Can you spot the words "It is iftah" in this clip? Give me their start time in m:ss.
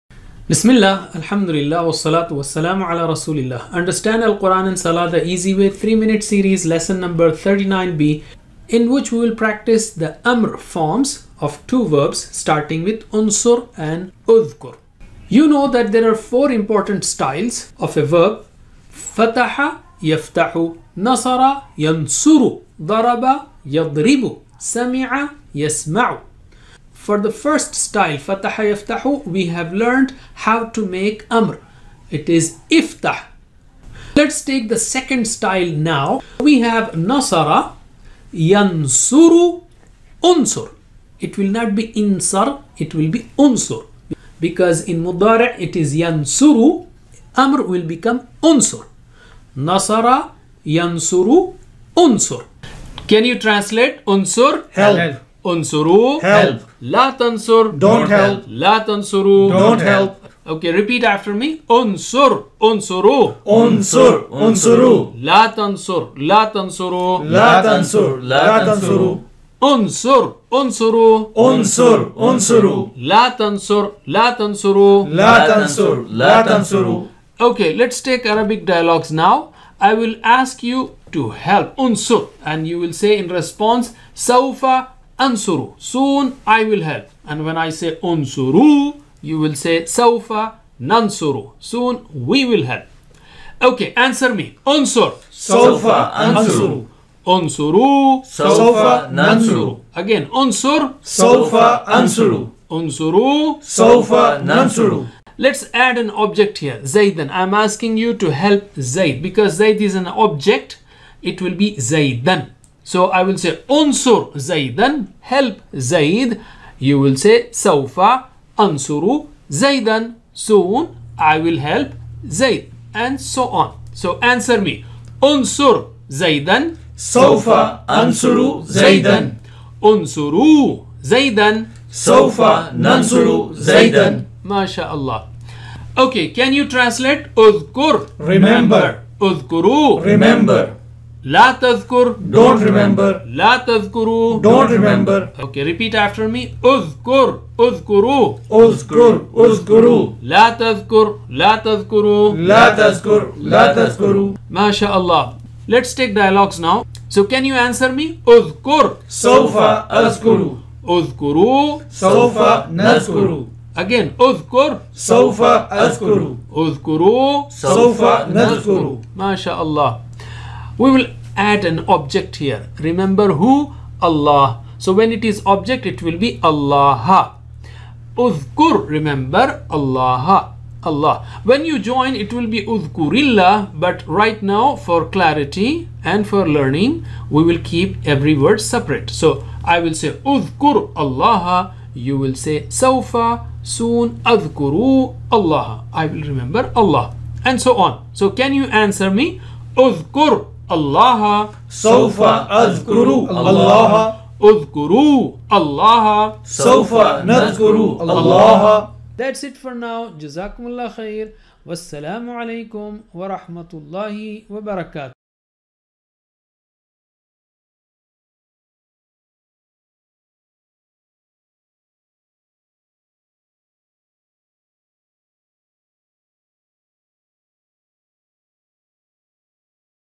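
0:32.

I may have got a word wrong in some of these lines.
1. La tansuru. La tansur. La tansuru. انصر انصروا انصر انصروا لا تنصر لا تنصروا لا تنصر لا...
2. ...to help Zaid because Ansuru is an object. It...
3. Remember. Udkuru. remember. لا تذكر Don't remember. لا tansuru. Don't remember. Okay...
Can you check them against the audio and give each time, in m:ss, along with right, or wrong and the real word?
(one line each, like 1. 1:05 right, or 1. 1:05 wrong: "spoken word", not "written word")
1. 1:06 right
2. 1:48 wrong: "Zaid", not "Ansuru"
3. 2:18 wrong: "tazkuru", not "tansuru".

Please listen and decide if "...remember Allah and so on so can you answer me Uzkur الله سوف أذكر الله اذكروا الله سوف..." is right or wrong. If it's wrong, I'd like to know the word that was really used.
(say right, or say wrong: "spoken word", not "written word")
right.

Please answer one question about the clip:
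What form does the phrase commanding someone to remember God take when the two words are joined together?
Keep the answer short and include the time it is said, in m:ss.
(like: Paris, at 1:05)
Uzkurillah, at 3:02.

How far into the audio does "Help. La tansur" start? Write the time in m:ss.
0:56.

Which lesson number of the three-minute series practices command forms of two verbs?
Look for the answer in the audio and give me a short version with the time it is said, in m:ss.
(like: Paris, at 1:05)
39b, at 0:06.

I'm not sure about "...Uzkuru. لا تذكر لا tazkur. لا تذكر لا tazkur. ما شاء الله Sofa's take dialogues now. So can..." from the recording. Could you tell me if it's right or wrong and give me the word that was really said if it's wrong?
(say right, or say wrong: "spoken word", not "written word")
wrong: "Let", not "Sofa".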